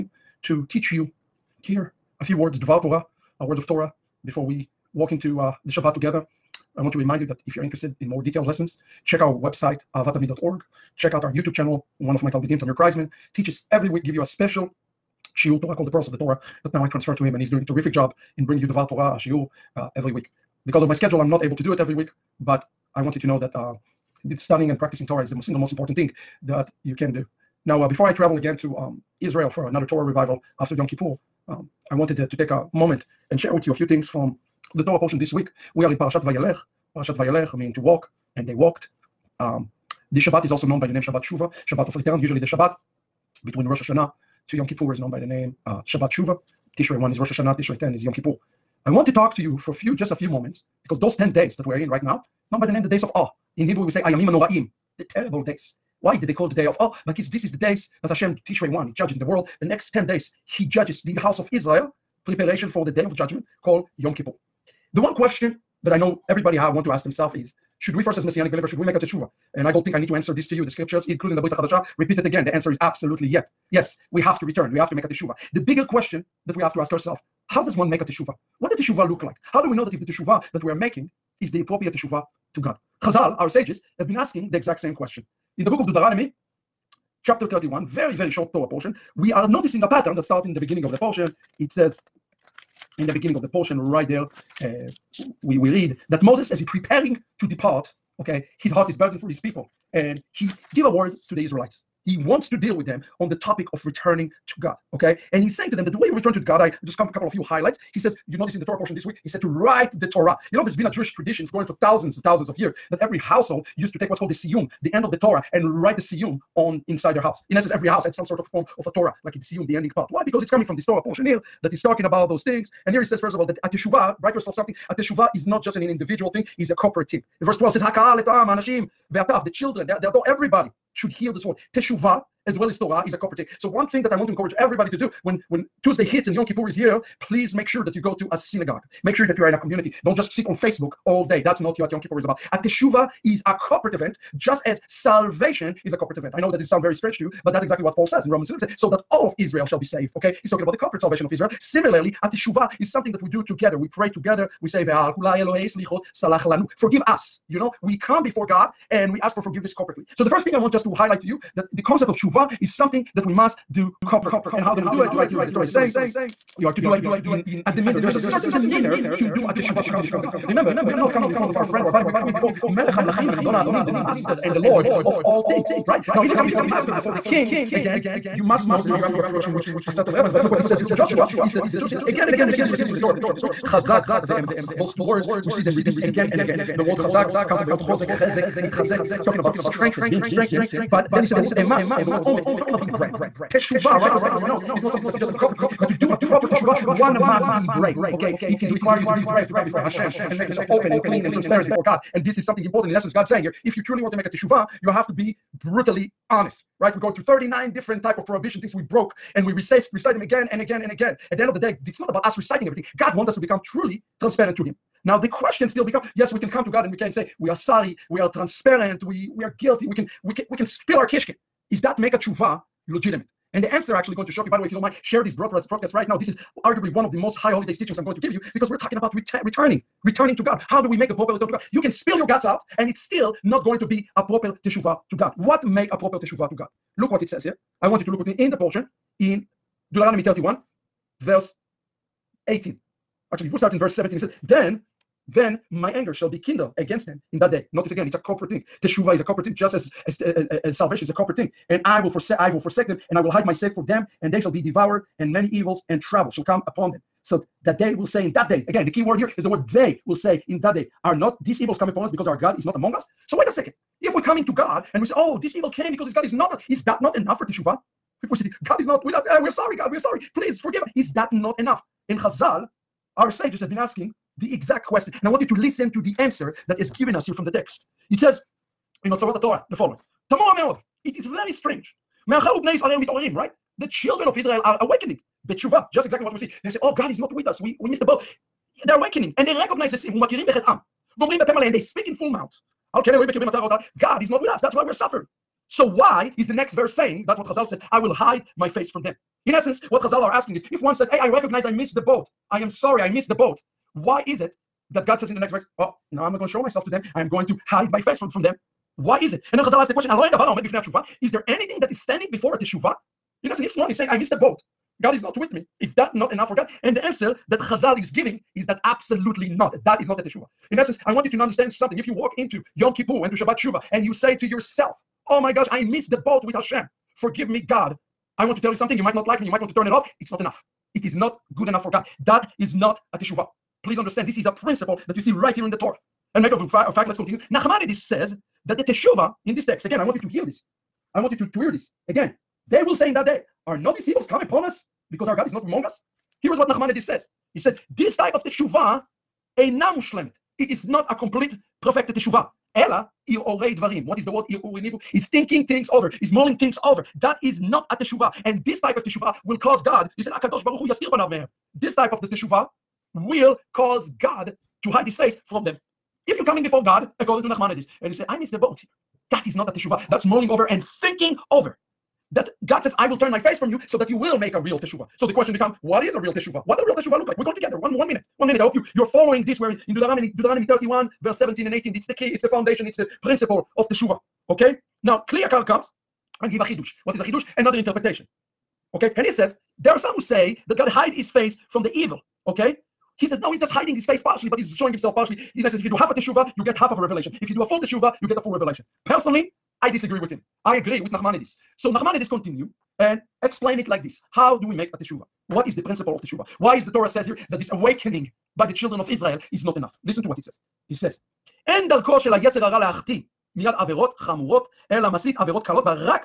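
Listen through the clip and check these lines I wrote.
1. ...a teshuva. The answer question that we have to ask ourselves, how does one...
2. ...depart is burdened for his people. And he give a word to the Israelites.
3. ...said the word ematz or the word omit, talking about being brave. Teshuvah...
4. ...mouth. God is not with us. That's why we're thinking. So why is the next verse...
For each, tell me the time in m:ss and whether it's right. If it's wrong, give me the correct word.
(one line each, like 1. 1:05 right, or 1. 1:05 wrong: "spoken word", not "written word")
1. 1:15 wrong: "bigger", not "answer"
2. 1:38 wrong: "heart", not "depart"
3. 3:11 right
4. 4:52 wrong: "suffering", not "thinking".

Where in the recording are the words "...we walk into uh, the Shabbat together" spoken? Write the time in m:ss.
0:04.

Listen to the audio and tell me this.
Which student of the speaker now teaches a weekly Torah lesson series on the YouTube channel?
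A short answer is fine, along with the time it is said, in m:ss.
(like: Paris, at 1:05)
Tamir Kreisman, at 0:12.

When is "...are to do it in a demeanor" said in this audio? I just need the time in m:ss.
2:46.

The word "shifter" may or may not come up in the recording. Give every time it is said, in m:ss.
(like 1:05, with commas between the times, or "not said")
not said.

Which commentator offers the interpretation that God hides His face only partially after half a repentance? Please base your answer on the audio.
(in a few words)
Kli Yakar.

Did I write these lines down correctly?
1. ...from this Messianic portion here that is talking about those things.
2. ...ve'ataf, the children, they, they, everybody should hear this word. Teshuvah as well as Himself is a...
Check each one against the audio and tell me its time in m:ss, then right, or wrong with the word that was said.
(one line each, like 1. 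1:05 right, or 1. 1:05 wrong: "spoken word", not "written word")
1. 2:00 wrong: "Torah", not "Messianic"
2. 2:09 wrong: "Torah", not "Himself".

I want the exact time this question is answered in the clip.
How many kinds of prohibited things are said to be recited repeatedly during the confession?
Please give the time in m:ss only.
3:27.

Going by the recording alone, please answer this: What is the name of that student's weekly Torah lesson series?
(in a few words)
Pearls of the Torah.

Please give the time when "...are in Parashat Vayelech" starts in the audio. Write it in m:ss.
0:35.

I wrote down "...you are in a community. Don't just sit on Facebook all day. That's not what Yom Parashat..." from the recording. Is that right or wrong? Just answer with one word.
wrong.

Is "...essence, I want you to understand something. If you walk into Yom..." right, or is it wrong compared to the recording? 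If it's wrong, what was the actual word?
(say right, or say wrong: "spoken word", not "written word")
right.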